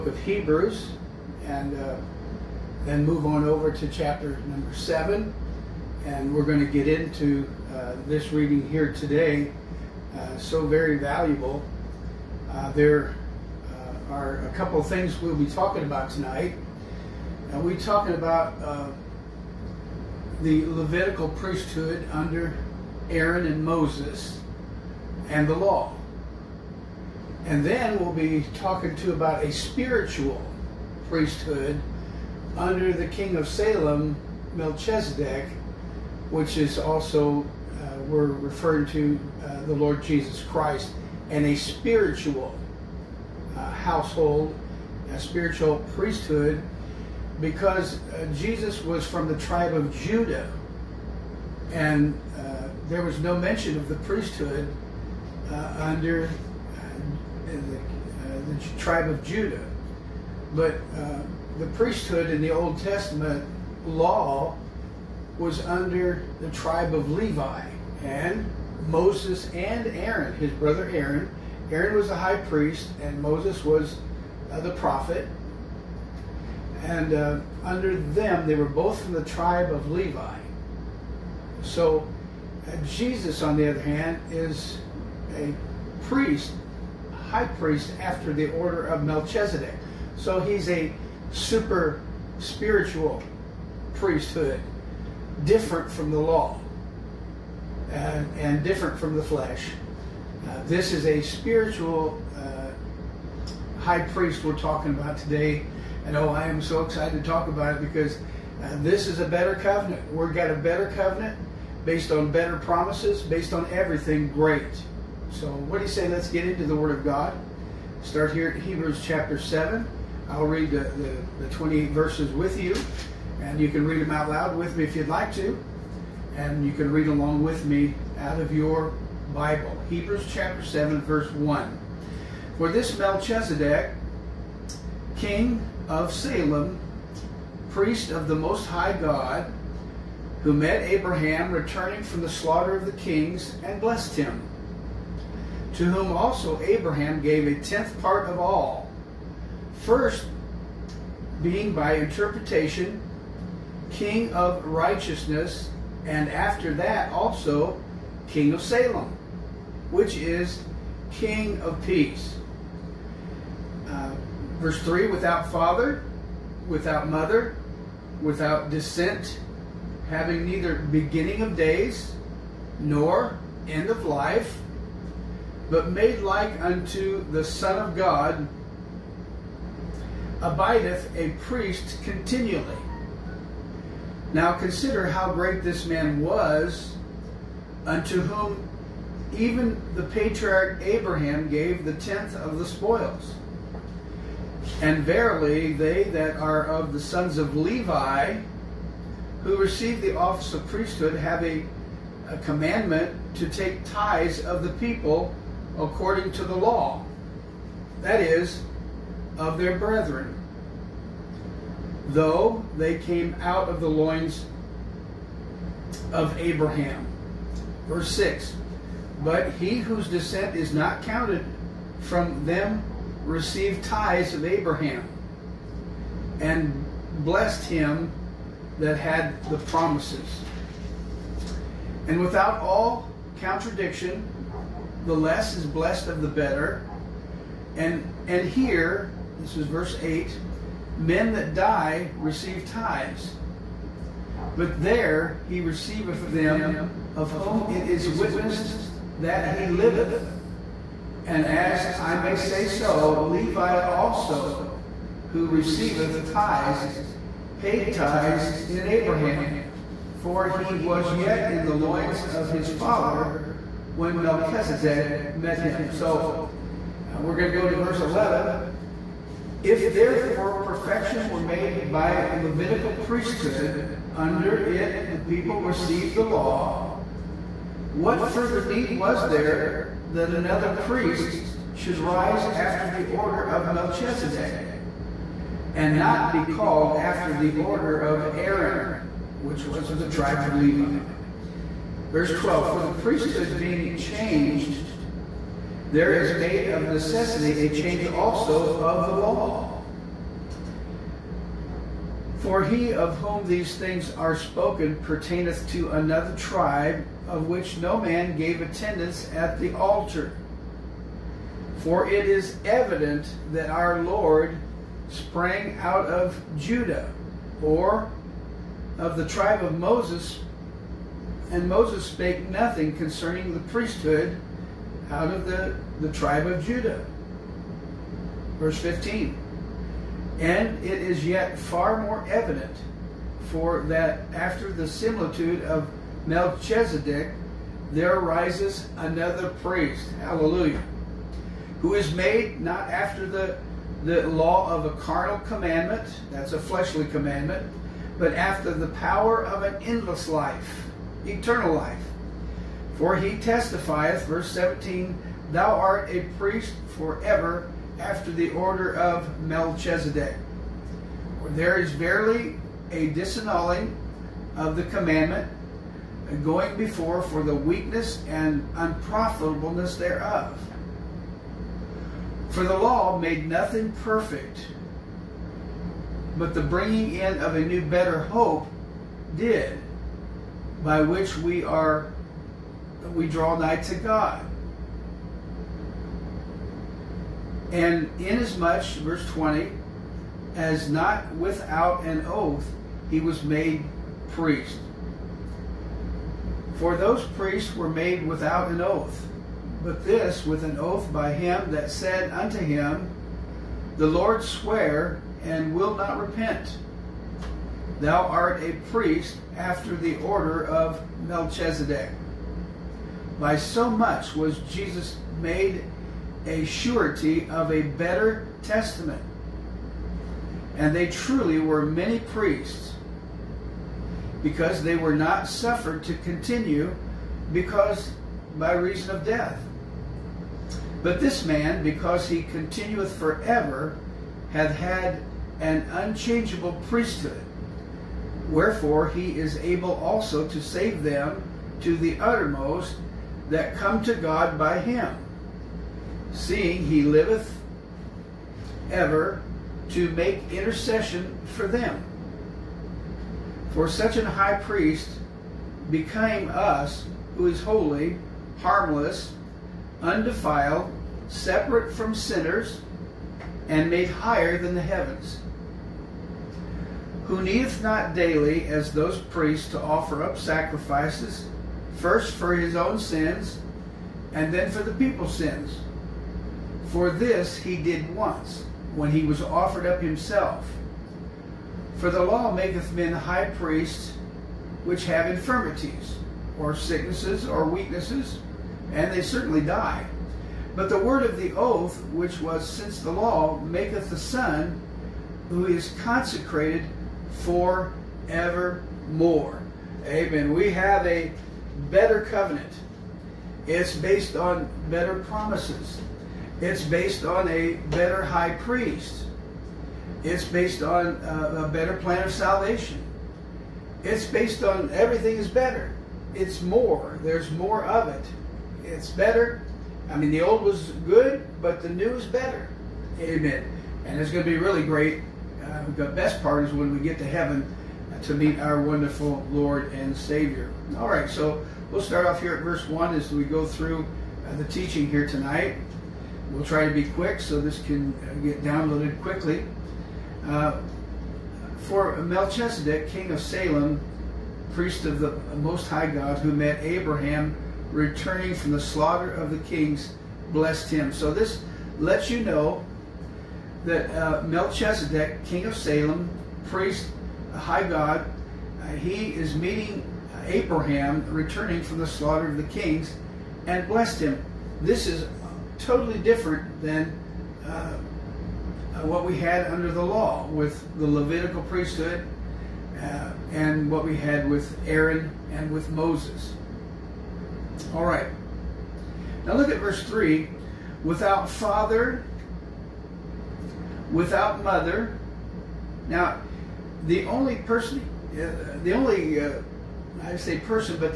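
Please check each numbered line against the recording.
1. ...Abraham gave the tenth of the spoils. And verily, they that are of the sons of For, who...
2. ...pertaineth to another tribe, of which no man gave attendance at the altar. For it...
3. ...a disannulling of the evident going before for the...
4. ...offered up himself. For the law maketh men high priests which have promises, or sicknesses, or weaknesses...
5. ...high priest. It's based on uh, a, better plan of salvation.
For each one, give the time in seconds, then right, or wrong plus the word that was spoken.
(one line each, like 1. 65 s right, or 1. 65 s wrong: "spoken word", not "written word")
1. 190 s wrong: "Levi", not "For"
2. 305 s right
3. 362 s wrong: "commandment", not "evident"
4. 479 s wrong: "infirmities", not "promises"
5. 508 s right.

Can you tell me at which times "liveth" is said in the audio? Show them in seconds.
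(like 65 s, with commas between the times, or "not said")
249 s, 447 s.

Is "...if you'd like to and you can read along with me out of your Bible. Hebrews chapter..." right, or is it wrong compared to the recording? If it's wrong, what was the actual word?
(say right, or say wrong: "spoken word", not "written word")
right.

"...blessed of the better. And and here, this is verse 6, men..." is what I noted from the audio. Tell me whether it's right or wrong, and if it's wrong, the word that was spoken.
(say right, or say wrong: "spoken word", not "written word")
wrong: "8", not "6".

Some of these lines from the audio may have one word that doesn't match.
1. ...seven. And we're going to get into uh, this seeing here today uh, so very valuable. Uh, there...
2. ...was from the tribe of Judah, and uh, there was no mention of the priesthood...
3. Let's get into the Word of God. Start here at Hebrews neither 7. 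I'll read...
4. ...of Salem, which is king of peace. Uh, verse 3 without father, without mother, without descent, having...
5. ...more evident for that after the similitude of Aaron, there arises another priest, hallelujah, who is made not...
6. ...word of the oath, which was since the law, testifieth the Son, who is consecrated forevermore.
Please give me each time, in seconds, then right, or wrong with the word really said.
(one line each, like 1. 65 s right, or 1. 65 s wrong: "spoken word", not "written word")
1. 4 s wrong: "reading", not "seeing"
2. 48 s right
3. 116 s wrong: "chapter", not "neither"
4. 158 s right
5. 332 s wrong: "Melchizedek", not "Aaron"
6. 490 s wrong: "maketh", not "testifieth".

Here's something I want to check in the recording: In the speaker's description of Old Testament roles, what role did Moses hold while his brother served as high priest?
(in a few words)
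the prophet.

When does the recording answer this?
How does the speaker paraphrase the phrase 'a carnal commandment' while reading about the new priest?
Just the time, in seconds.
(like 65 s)
346 s.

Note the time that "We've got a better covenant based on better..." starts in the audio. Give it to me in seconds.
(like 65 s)
110 s.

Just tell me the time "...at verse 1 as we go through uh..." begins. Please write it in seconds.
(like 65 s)
532 s.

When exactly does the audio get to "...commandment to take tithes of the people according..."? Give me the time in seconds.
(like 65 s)
202 s.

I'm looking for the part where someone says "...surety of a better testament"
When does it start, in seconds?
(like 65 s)
416 s.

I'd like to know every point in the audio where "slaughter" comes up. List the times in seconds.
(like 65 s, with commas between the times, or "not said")
142 s, 548 s, 562 s.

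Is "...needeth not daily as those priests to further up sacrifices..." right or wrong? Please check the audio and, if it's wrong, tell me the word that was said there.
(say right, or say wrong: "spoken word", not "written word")
wrong: "offer", not "further".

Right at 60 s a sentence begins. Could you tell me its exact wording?
But the priesthood in the Old Testament law was under the tribe of Levi and Moses and Aaron, his brother Aaron.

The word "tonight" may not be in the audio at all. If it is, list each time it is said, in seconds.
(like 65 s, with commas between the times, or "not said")
16 s, 535 s.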